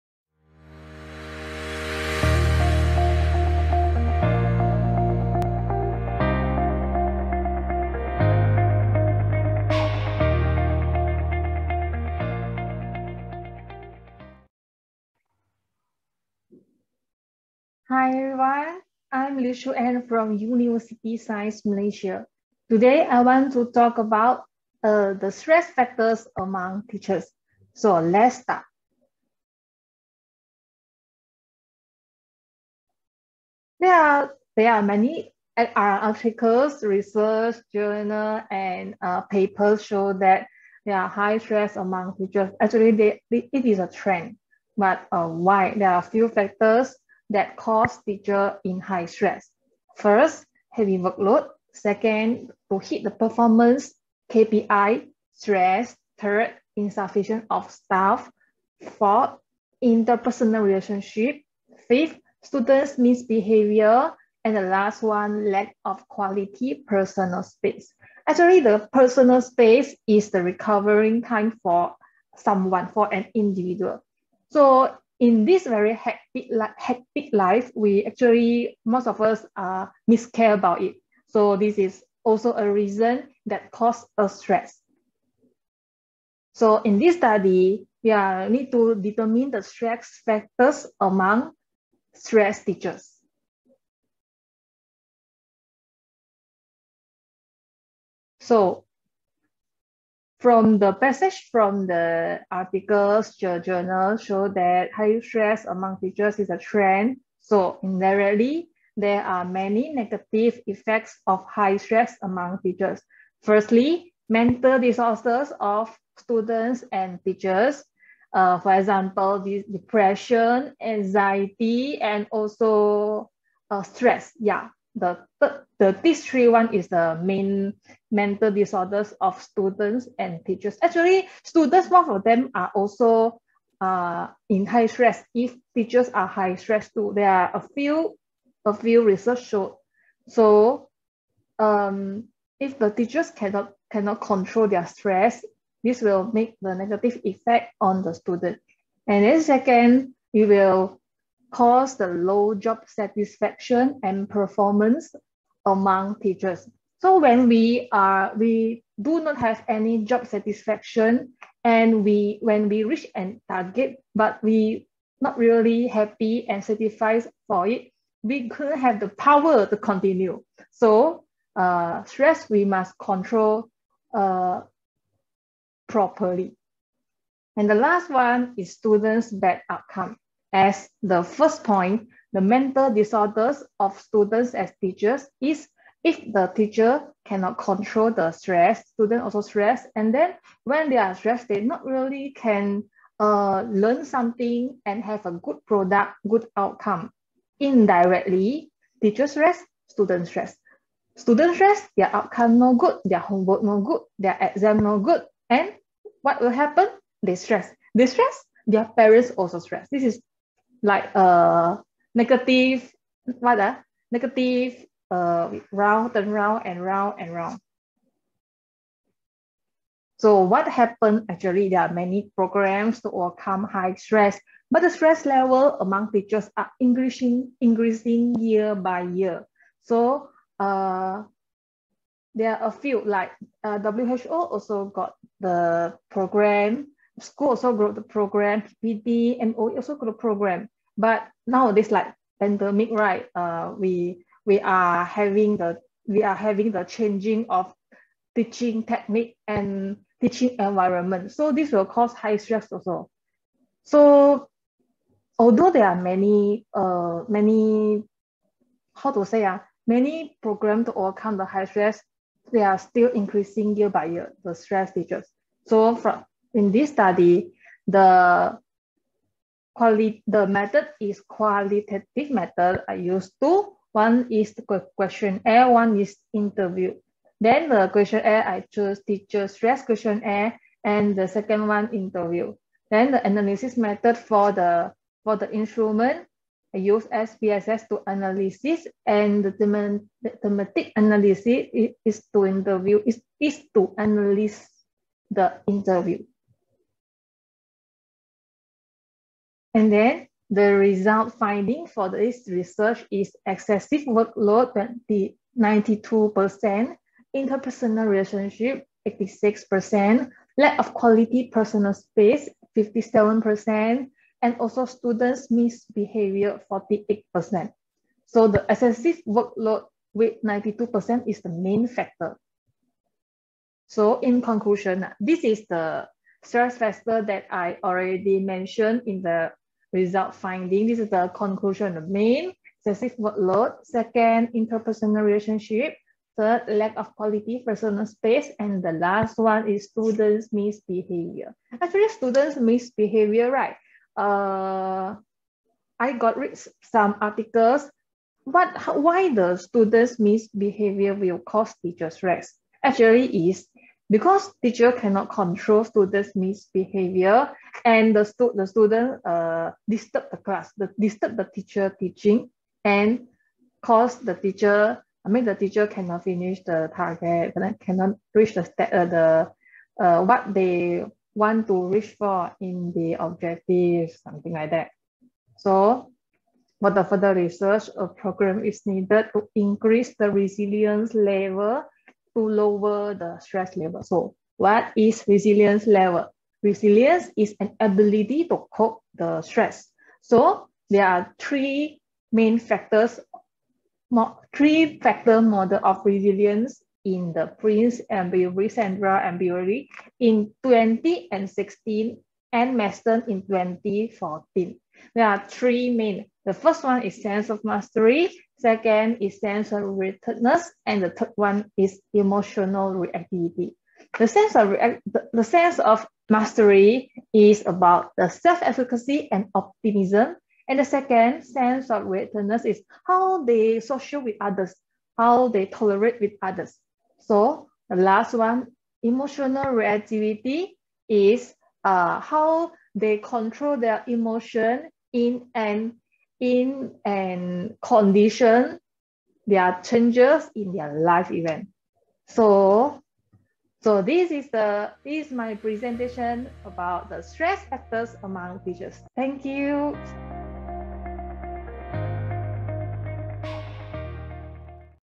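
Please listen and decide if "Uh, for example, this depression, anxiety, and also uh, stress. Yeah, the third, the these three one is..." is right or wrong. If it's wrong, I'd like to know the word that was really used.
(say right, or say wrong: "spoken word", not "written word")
right.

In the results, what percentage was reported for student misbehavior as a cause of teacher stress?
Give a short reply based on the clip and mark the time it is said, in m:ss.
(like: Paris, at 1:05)
48%, at 5:16.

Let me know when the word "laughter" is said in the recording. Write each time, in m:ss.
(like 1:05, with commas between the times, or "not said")
not said.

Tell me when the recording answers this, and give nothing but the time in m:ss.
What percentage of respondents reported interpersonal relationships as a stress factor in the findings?
5:09.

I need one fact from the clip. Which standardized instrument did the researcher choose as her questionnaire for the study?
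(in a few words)
Teacher Stress Questionnaire.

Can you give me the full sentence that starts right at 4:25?
So from in this study, the quality, the method is qualitative method.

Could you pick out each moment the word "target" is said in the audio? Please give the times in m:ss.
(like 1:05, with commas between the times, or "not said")
2:43, 6:06.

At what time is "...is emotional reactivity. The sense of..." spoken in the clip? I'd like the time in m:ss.
6:51.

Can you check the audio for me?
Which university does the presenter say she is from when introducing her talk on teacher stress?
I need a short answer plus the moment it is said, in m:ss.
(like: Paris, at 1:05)
University Science Malaysia, at 0:20.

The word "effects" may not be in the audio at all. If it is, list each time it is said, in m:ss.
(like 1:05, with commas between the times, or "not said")
1:50, 2:27.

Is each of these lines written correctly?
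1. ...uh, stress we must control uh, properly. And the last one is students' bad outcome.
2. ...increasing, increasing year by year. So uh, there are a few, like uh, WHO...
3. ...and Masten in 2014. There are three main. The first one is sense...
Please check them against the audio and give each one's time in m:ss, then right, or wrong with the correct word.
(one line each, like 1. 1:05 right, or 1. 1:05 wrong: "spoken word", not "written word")
1. 2:51 right
2. 3:46 right
3. 6:42 right.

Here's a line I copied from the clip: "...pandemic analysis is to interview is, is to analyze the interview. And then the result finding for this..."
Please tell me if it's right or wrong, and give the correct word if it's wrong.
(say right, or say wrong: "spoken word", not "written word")
wrong: "thematic", not "pandemic".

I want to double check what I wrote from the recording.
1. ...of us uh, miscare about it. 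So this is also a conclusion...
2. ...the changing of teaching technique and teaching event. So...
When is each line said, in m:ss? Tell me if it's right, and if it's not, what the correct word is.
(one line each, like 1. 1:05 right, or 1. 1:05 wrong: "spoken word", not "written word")
1. 1:19 wrong: "reason", not "conclusion"
2. 4:06 wrong: "environment", not "event".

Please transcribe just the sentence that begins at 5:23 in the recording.
So in conclusion, this is the stress factor that I already mentioned in the result finding.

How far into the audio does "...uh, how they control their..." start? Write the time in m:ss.
7:11.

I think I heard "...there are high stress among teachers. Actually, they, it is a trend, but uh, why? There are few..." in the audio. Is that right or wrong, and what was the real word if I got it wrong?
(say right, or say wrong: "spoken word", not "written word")
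right.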